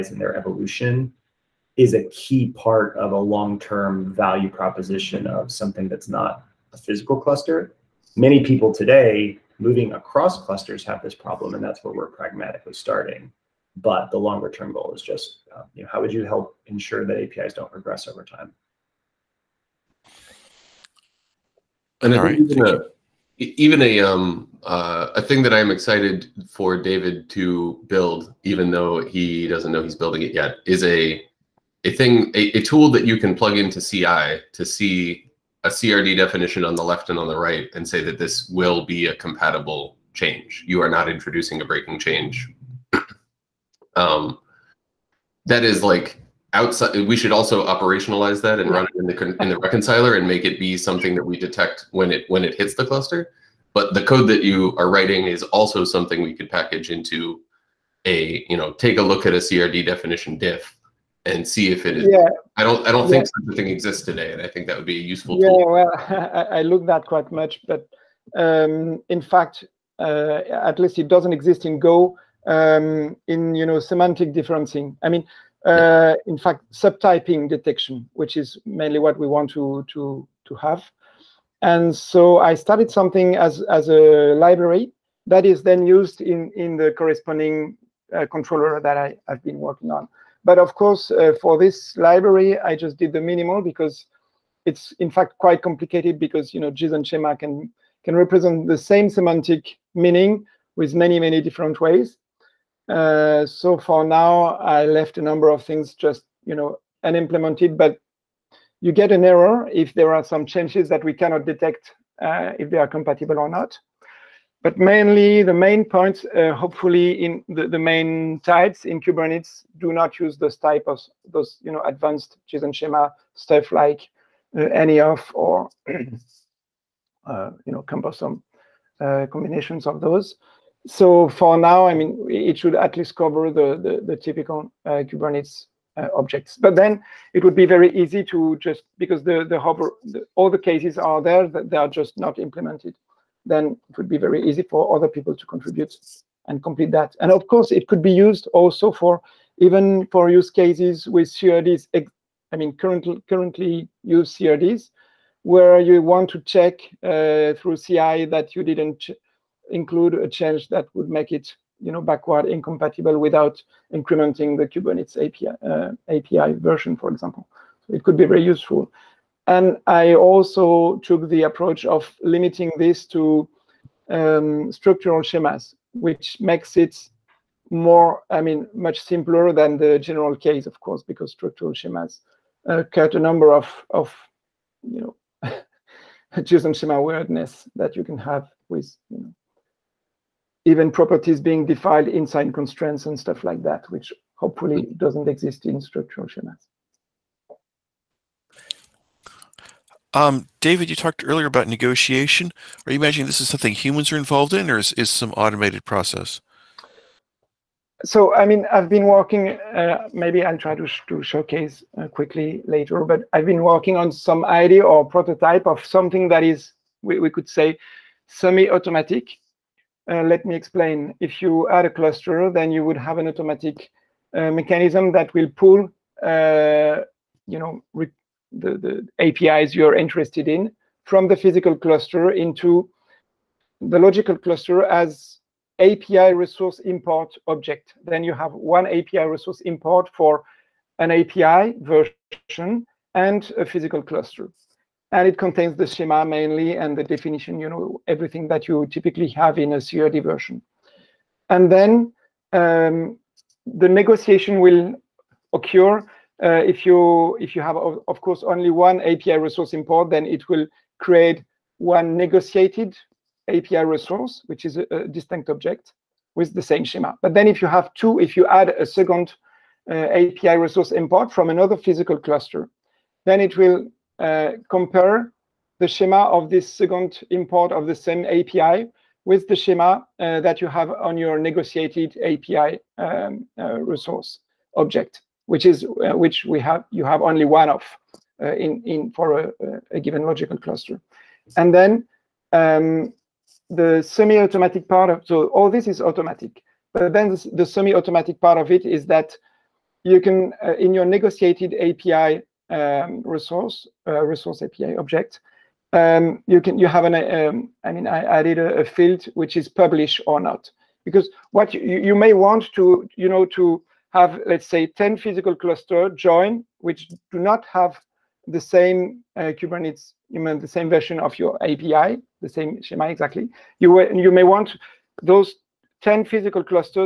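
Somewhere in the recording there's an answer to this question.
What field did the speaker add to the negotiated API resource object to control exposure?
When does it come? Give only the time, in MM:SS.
05:09.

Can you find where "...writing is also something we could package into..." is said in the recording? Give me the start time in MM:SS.
00:54.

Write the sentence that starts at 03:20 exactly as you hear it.
Um, David, you talked earlier about negotiation.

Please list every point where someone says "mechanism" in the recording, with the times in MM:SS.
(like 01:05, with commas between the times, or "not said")
03:44.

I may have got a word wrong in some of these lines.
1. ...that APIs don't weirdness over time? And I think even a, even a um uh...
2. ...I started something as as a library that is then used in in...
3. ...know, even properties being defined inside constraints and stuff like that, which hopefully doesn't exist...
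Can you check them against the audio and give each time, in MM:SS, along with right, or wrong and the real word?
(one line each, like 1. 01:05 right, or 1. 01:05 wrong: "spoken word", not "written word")
1. 00:17 wrong: "regress", not "weirdness"
2. 01:22 right
3. 03:09 right.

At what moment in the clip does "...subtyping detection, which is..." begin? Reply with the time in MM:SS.
01:16.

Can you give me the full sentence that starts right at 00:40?
You are not introducing a breaking change.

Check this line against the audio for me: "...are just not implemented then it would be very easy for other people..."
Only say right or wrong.
right.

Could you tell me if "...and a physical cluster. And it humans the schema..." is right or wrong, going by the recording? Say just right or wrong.
wrong.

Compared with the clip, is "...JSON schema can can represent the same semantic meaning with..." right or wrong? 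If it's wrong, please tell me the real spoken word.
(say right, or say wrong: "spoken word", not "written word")
right.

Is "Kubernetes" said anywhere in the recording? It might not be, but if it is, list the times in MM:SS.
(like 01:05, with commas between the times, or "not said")
01:58, 02:15, 02:44, 05:19.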